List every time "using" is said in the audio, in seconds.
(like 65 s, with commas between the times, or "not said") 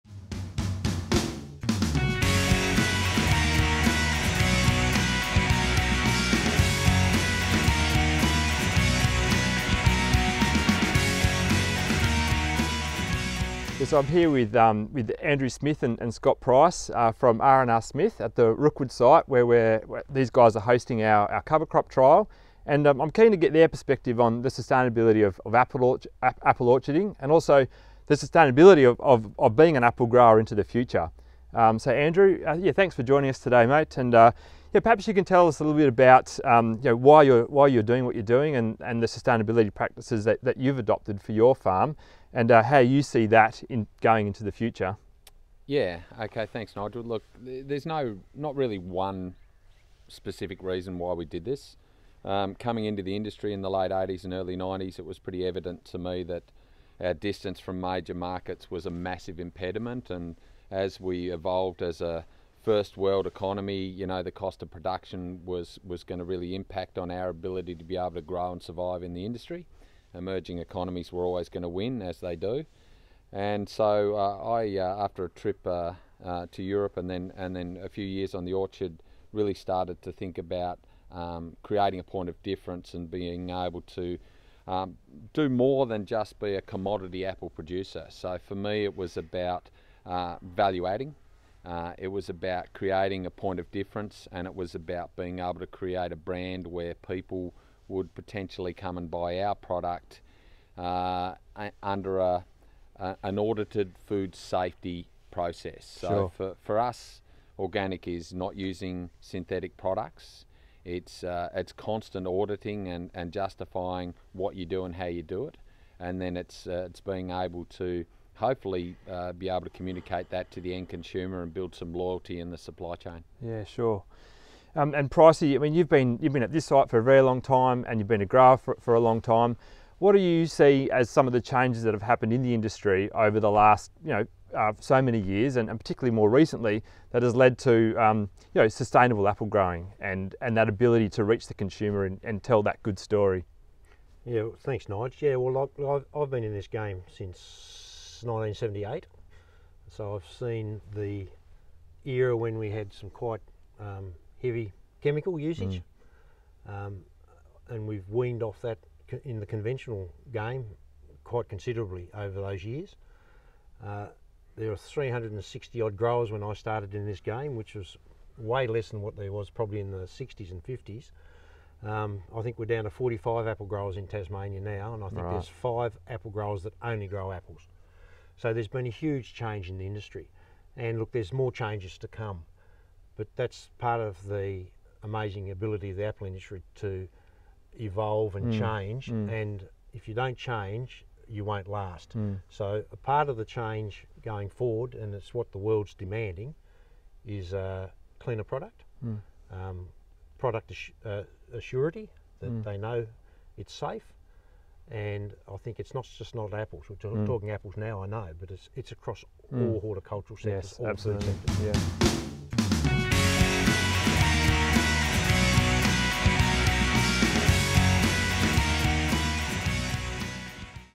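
108 s.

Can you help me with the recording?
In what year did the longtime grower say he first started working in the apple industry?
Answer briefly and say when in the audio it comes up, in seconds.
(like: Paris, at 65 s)
1978, at 148 s.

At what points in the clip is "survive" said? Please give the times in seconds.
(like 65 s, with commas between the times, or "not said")
68 s.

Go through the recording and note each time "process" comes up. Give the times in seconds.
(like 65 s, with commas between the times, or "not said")
105 s.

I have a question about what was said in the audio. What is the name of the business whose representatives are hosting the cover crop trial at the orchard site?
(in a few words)
R&R Smith.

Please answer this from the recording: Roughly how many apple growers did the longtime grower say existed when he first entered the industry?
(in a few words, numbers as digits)
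360.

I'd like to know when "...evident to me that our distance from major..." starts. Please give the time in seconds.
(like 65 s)
55 s.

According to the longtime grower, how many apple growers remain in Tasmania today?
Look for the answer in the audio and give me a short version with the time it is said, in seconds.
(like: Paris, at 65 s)
45, at 172 s.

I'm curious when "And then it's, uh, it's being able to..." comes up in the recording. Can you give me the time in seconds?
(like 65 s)
115 s.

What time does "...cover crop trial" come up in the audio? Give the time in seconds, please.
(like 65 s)
21 s.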